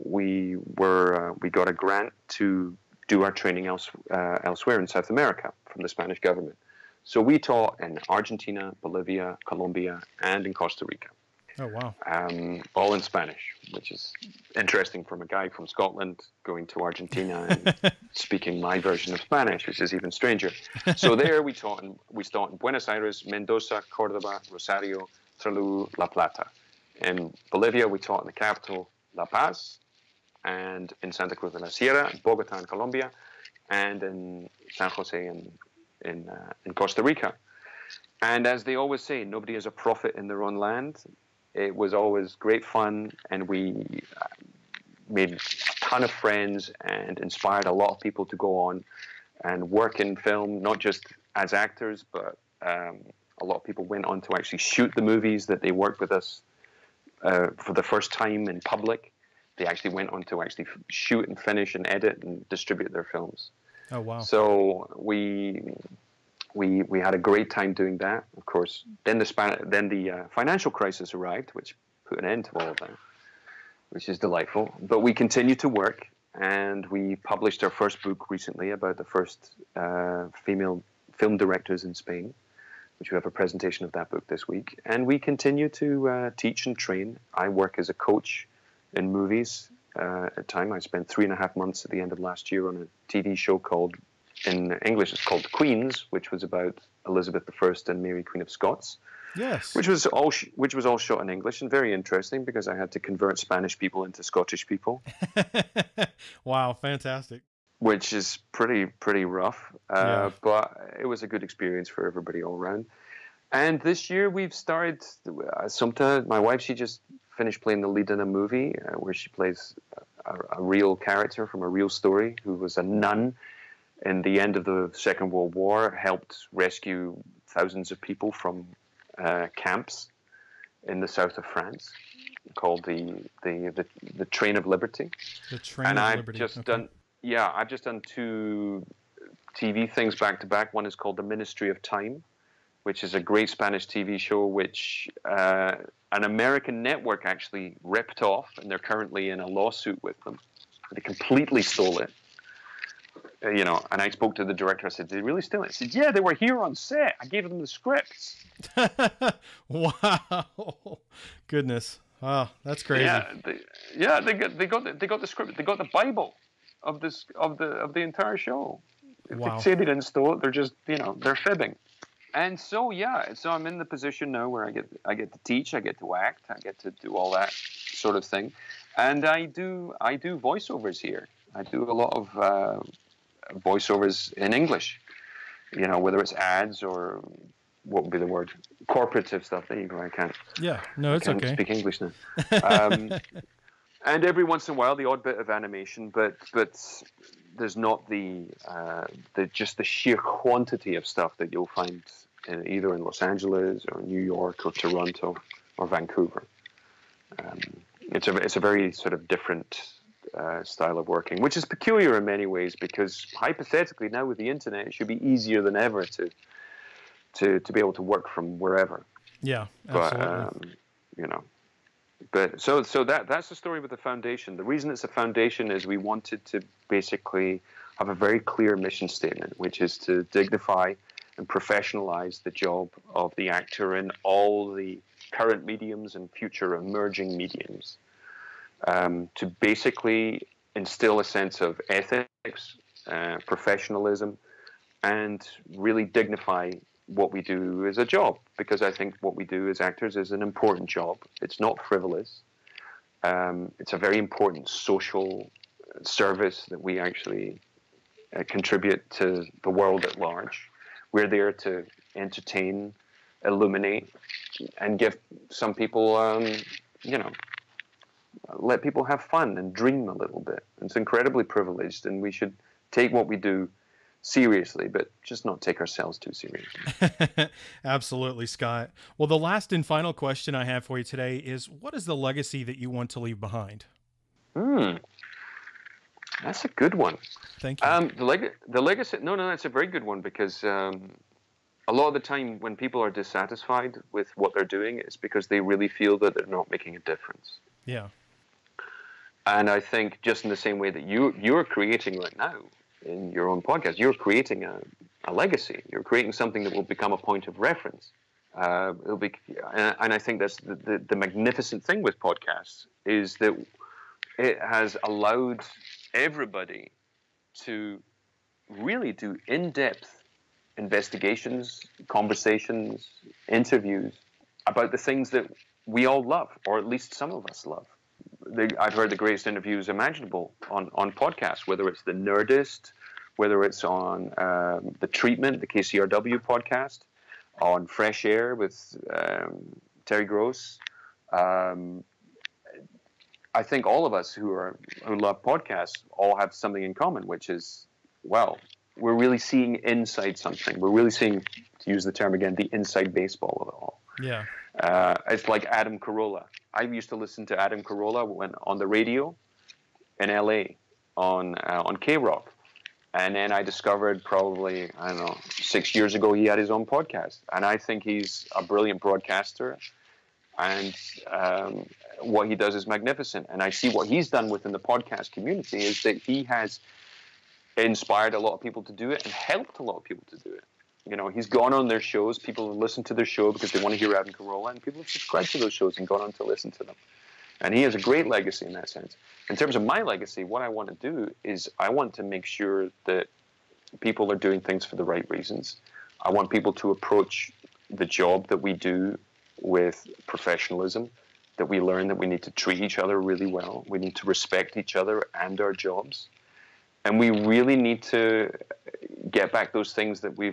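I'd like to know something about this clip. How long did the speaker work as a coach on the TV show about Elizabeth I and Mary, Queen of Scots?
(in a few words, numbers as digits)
3.5 months.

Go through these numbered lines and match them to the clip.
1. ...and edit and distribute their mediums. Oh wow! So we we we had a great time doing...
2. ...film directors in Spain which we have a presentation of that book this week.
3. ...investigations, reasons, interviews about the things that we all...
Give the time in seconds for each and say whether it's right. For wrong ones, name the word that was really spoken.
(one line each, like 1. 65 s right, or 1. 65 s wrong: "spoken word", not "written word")
1. 61 s wrong: "films", not "mediums"
2. 81 s right
3. 320 s wrong: "conversations", not "reasons".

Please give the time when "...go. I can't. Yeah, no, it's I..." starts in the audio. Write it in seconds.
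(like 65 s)
189 s.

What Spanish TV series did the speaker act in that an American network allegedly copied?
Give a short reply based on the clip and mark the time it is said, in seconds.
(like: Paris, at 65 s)
The Ministry of Time, at 141 s.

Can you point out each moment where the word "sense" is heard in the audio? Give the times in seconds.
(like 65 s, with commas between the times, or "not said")
241 s, 388 s.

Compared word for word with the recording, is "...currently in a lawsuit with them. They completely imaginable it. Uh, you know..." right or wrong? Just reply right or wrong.
wrong.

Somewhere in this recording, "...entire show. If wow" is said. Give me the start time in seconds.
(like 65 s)
168 s.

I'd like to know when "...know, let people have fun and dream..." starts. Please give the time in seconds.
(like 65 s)
267 s.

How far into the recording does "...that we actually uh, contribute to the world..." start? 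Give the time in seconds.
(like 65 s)
256 s.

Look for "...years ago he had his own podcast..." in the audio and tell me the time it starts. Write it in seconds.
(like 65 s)
365 s.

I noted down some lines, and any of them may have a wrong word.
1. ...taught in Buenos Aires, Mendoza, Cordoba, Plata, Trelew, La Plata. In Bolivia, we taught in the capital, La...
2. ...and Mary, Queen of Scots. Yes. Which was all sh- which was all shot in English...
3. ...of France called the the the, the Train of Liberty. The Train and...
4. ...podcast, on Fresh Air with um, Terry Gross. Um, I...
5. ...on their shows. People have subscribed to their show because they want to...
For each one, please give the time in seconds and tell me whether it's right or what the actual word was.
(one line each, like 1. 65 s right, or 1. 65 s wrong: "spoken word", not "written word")
1. 22 s wrong: "Rosario", not "Plata"
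2. 97 s right
3. 131 s right
4. 336 s right
5. 381 s wrong: "listened", not "subscribed".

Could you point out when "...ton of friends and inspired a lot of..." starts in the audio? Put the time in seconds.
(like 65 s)
45 s.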